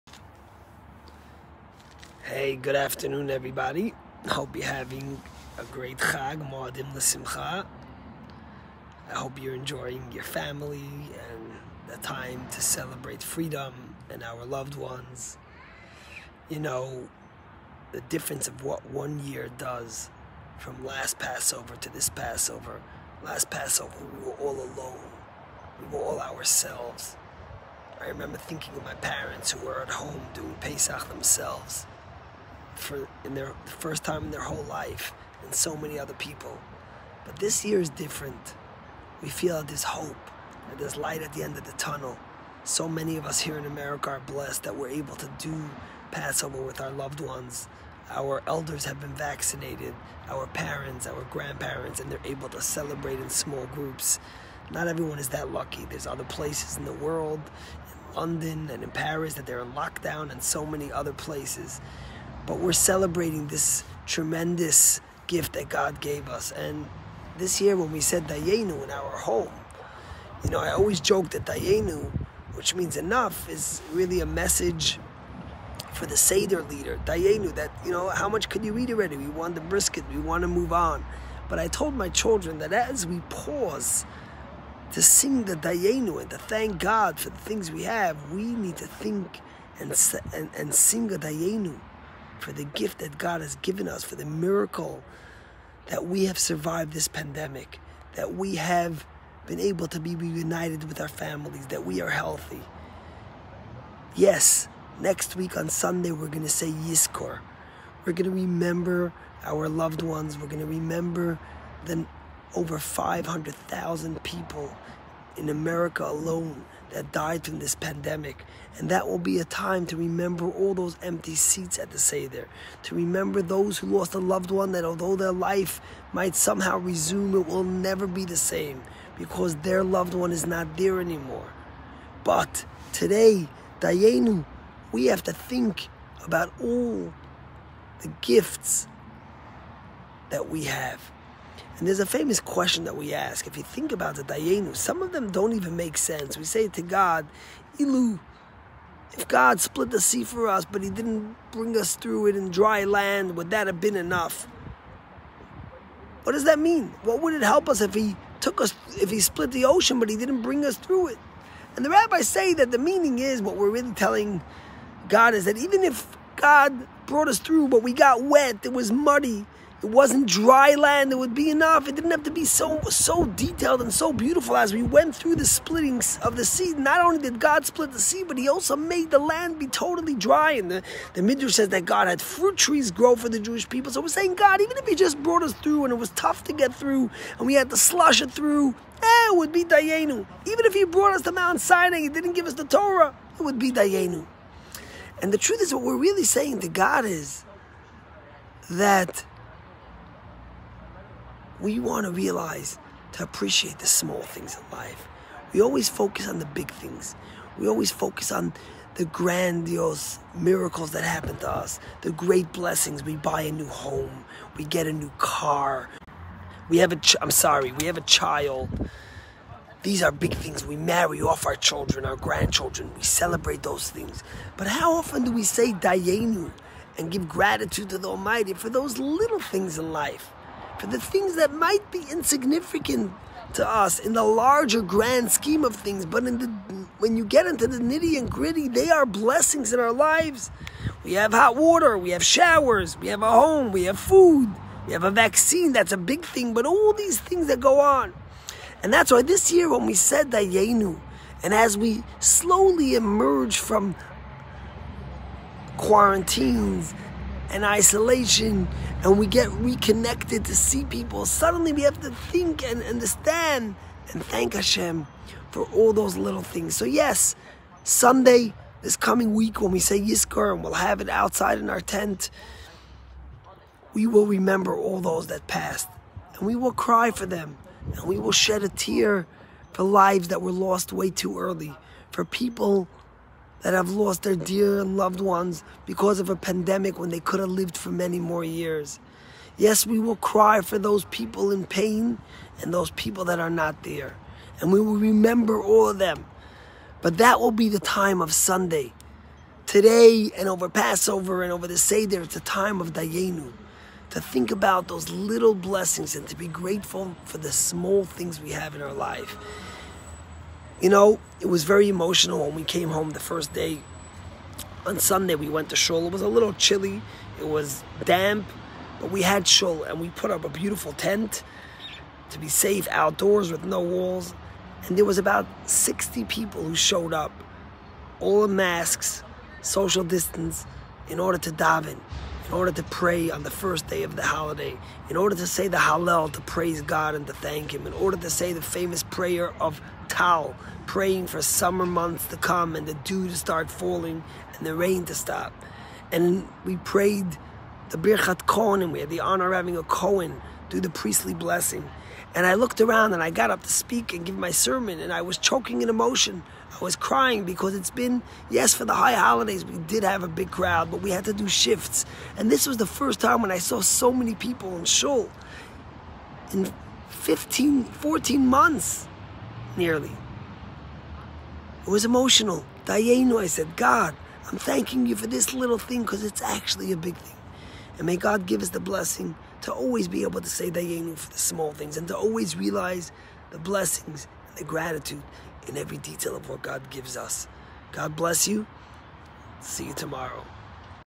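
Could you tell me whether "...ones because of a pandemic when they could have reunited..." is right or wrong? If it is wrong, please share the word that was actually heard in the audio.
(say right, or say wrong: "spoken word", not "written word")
wrong: "lived", not "reunited".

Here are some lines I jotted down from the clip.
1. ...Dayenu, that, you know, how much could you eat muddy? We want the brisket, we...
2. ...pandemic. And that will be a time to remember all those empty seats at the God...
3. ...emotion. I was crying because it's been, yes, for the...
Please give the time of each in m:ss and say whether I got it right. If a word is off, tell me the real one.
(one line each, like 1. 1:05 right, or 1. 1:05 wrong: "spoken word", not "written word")
1. 1:17 wrong: "already", not "muddy"
2. 1:57 wrong: "Seder", not "God"
3. 5:55 right.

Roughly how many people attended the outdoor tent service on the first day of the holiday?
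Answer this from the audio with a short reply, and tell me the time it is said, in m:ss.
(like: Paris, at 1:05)
60, at 5:25.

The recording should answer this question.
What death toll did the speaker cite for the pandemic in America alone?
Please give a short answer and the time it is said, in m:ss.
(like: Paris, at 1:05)
500,000, at 1:52.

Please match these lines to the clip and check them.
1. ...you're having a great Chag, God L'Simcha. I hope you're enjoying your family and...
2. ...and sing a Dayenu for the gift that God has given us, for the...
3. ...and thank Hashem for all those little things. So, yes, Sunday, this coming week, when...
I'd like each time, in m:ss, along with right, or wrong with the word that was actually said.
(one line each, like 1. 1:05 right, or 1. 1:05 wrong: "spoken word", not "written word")
1. 0:04 wrong: "Moadim", not "God"
2. 1:30 right
3. 4:24 right.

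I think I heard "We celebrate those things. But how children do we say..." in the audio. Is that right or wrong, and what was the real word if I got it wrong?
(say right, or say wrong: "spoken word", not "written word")
wrong: "often", not "children".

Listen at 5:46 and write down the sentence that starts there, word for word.
And we prayed the Birchat Kohen, we had the honor of having a Kohen do the priestly blessing.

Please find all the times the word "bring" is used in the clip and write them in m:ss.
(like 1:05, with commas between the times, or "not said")
2:31, 2:40.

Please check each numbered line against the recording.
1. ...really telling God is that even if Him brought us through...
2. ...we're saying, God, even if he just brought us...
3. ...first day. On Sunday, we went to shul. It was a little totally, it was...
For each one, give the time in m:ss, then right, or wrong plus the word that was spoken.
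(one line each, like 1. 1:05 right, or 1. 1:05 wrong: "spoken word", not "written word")
1. 2:43 wrong: "God", not "Him"
2. 3:04 right
3. 5:13 wrong: "chilly", not "totally".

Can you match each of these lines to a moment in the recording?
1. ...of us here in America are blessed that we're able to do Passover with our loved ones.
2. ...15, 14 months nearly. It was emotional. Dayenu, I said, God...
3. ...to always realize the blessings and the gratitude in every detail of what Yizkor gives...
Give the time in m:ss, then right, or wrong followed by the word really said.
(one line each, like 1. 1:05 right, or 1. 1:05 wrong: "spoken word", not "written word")
1. 0:43 right
2. 6:07 right
3. 6:22 wrong: "God", not "Yizkor".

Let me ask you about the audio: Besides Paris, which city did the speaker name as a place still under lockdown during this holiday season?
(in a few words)
London.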